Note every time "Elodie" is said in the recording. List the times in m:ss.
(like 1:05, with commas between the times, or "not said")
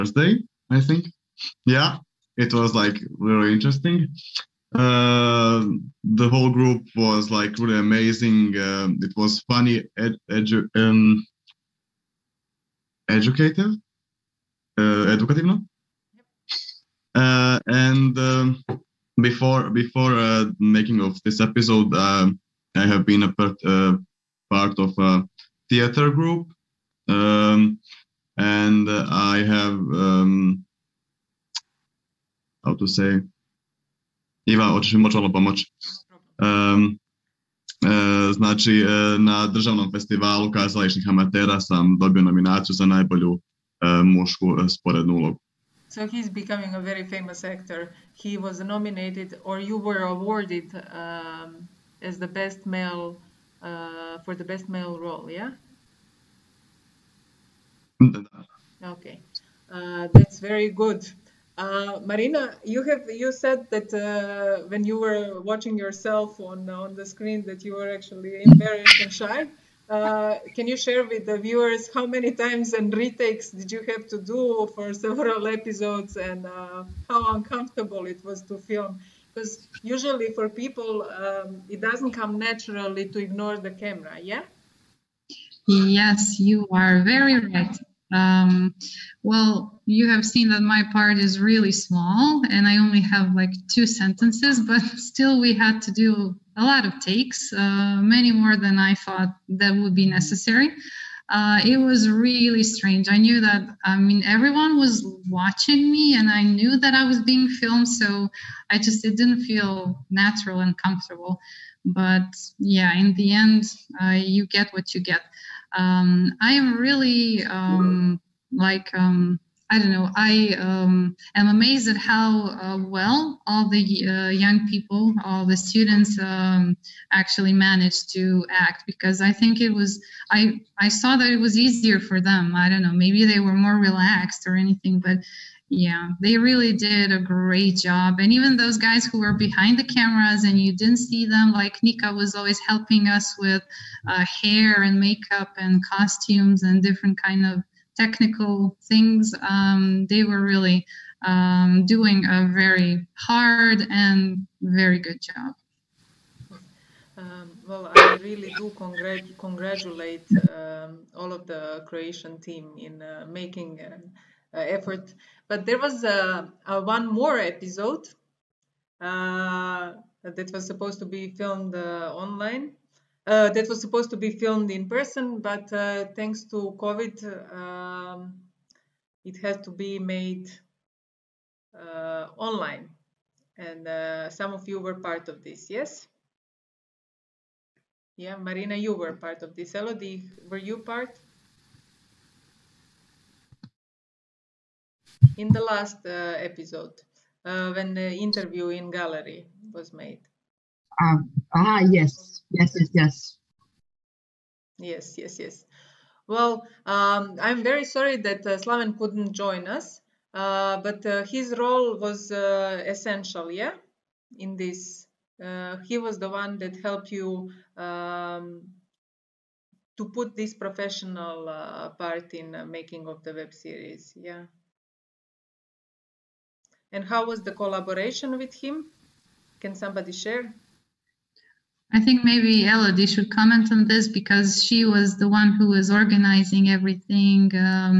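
3:09, 3:52.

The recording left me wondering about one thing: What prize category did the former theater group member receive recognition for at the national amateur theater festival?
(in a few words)
Best male role.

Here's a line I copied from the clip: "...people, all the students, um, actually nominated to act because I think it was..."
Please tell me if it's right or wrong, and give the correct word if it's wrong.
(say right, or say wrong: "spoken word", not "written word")
wrong: "managed", not "nominated".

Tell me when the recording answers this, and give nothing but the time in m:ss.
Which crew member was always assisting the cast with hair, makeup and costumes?
2:21.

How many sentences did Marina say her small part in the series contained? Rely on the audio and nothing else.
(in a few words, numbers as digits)
2.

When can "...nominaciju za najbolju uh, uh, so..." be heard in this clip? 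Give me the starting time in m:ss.
0:42.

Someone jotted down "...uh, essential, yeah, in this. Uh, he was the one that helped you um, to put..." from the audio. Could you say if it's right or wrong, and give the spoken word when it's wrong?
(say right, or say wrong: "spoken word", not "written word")
right.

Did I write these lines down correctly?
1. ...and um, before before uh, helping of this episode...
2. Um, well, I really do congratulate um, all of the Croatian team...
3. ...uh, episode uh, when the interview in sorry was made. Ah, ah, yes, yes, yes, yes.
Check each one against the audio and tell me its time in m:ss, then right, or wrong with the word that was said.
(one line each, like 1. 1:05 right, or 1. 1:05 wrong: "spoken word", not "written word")
1. 0:17 wrong: "making", not "helping"
2. 2:37 right
3. 3:16 wrong: "gallery", not "sorry".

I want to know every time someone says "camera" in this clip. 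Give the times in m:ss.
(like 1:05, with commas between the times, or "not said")
1:23, 2:19.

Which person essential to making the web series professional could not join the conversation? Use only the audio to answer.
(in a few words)
Slaven.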